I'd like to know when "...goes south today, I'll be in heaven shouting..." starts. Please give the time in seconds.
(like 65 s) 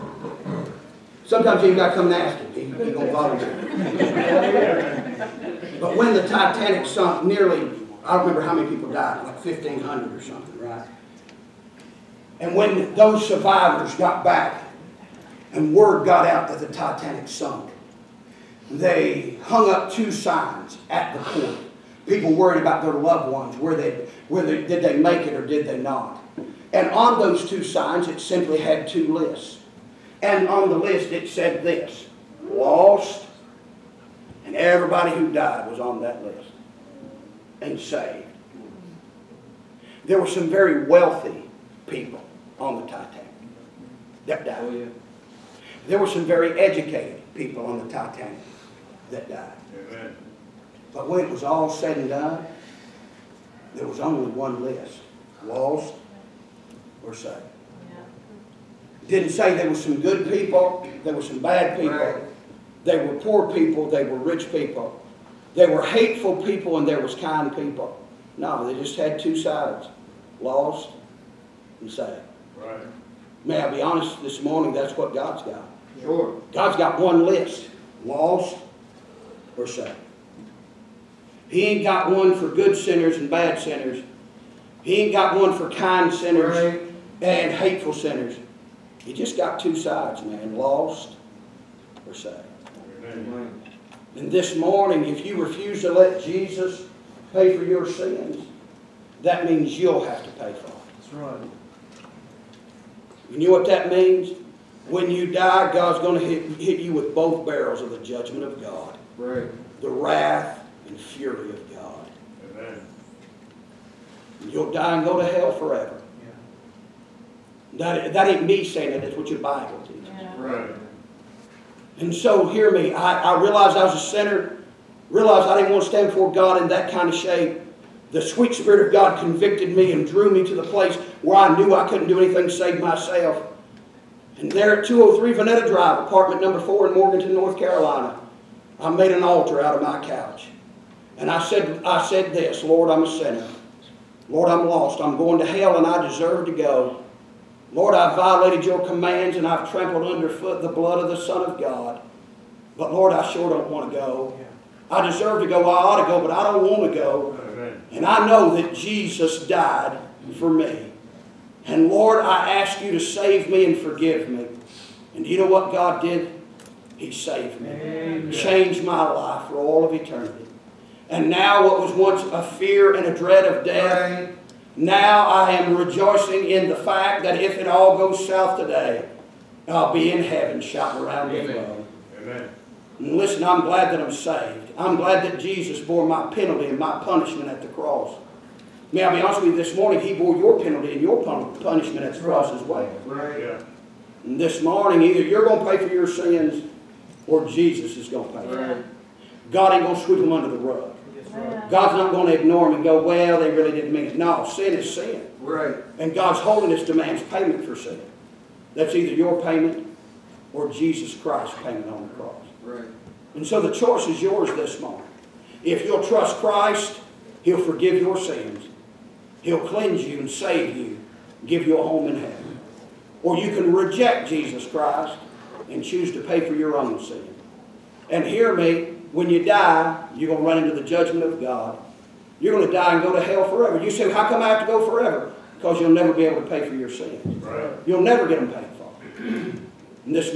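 177 s.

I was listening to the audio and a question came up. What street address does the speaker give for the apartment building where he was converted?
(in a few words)
203 Veneta Drive.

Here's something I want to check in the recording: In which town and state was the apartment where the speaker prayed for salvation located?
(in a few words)
Morganton, North Carolina.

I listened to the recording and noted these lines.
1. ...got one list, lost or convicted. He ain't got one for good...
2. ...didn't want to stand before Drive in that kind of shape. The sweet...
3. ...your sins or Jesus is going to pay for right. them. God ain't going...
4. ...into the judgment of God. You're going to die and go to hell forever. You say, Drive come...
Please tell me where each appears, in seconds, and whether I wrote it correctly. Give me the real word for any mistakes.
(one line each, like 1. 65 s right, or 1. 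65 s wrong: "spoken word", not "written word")
1. 76 s wrong: "saved", not "convicted"
2. 125 s wrong: "God", not "Drive"
3. 195 s right
4. 230 s wrong: "How", not "Drive".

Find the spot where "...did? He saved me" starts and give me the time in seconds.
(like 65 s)
166 s.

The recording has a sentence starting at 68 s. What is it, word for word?
No, they just had two sides, lost and saved.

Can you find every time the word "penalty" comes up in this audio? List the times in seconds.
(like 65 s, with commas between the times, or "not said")
186 s, 190 s.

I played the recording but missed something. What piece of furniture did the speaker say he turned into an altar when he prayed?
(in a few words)
Couch.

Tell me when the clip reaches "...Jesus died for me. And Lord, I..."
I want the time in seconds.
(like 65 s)
158 s.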